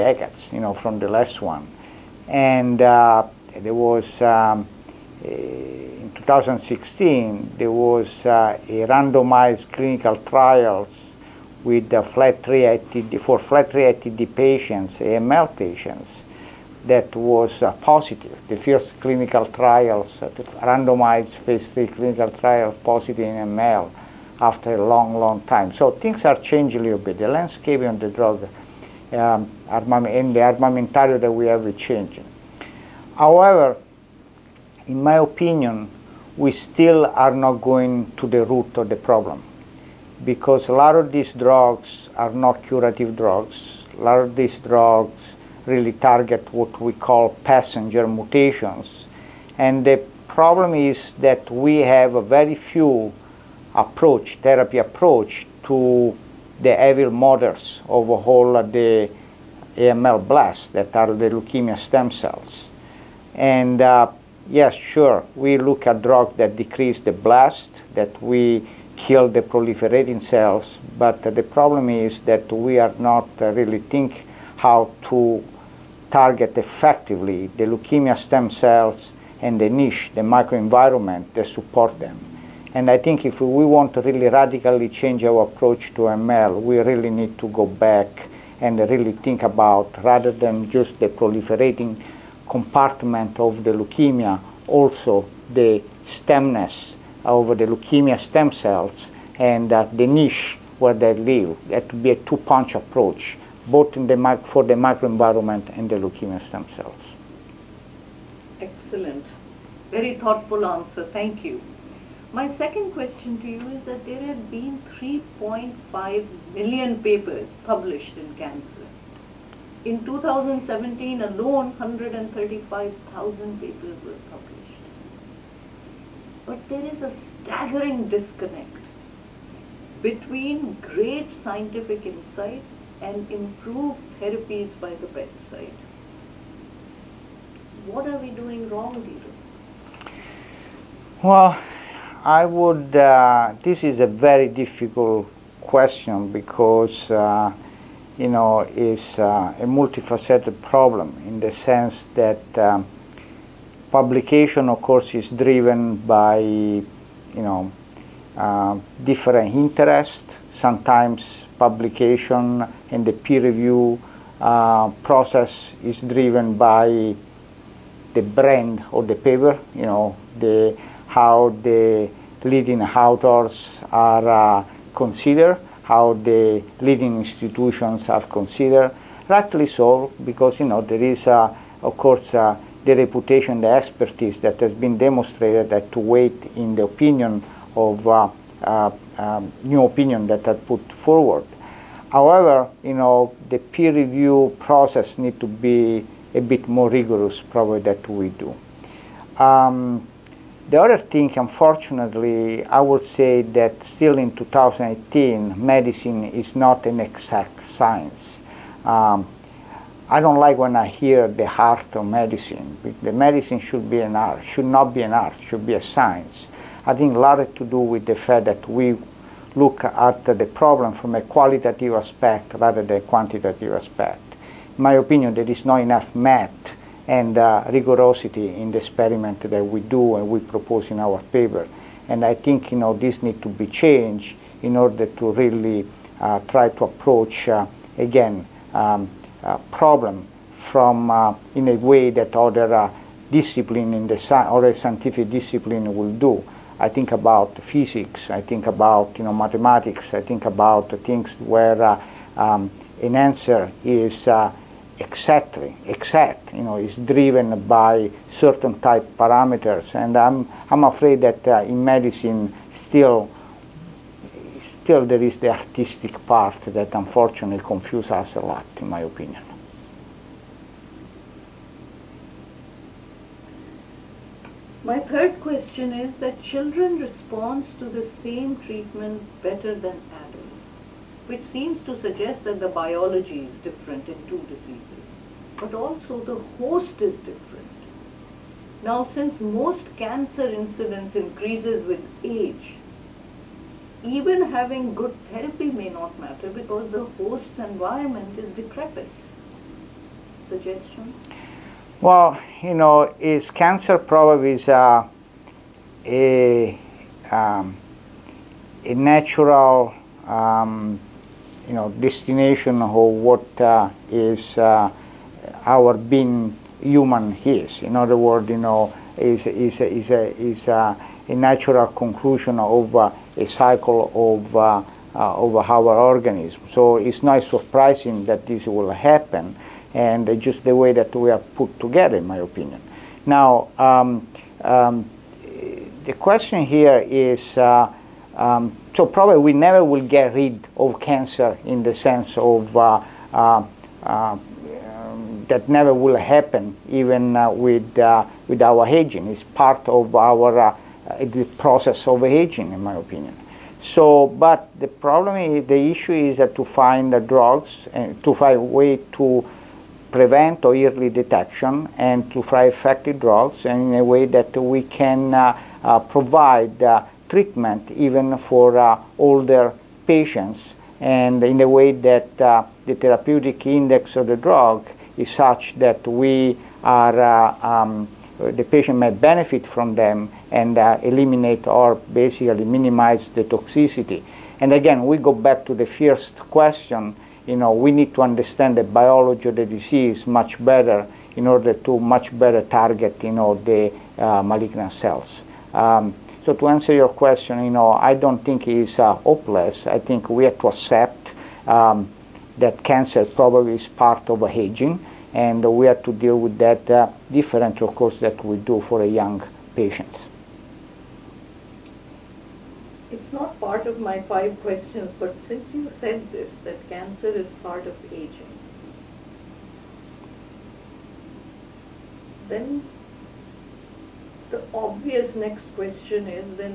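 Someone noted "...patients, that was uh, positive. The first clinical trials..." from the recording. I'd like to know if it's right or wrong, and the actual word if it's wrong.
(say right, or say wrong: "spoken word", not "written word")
right.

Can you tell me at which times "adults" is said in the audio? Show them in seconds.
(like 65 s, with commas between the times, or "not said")
280 s.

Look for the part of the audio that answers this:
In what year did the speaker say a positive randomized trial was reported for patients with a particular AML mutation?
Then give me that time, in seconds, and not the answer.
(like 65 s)
6 s.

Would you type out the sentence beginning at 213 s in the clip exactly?
The medicine should be an art, should not be an art, should be a science.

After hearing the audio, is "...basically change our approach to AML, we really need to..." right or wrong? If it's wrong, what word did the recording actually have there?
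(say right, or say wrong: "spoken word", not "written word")
wrong: "radically", not "basically".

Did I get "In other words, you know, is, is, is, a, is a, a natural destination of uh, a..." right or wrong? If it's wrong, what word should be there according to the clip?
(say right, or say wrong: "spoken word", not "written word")
wrong: "conclusion", not "destination".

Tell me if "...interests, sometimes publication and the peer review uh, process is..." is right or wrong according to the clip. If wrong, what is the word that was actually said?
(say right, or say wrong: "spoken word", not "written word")
right.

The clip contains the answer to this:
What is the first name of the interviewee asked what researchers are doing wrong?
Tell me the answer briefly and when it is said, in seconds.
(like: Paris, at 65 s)
Guido, at 138 s.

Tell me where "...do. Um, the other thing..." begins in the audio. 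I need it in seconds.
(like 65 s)
198 s.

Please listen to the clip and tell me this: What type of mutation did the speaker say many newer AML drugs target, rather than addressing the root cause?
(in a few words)
passenger mutations.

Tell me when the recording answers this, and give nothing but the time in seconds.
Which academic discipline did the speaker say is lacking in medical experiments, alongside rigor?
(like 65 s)
226 s.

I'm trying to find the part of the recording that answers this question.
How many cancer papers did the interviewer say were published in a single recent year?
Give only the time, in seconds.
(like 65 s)
121 s.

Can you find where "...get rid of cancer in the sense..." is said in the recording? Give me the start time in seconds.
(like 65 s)
340 s.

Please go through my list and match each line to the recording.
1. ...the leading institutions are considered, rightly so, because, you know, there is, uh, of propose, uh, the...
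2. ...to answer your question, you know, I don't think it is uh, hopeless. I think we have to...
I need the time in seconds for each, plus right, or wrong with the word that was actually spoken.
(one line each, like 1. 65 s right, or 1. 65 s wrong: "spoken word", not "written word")
1. 176 s wrong: "course", not "propose"
2. 396 s right.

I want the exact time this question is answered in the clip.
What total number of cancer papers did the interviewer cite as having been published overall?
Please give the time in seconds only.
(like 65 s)
114 s.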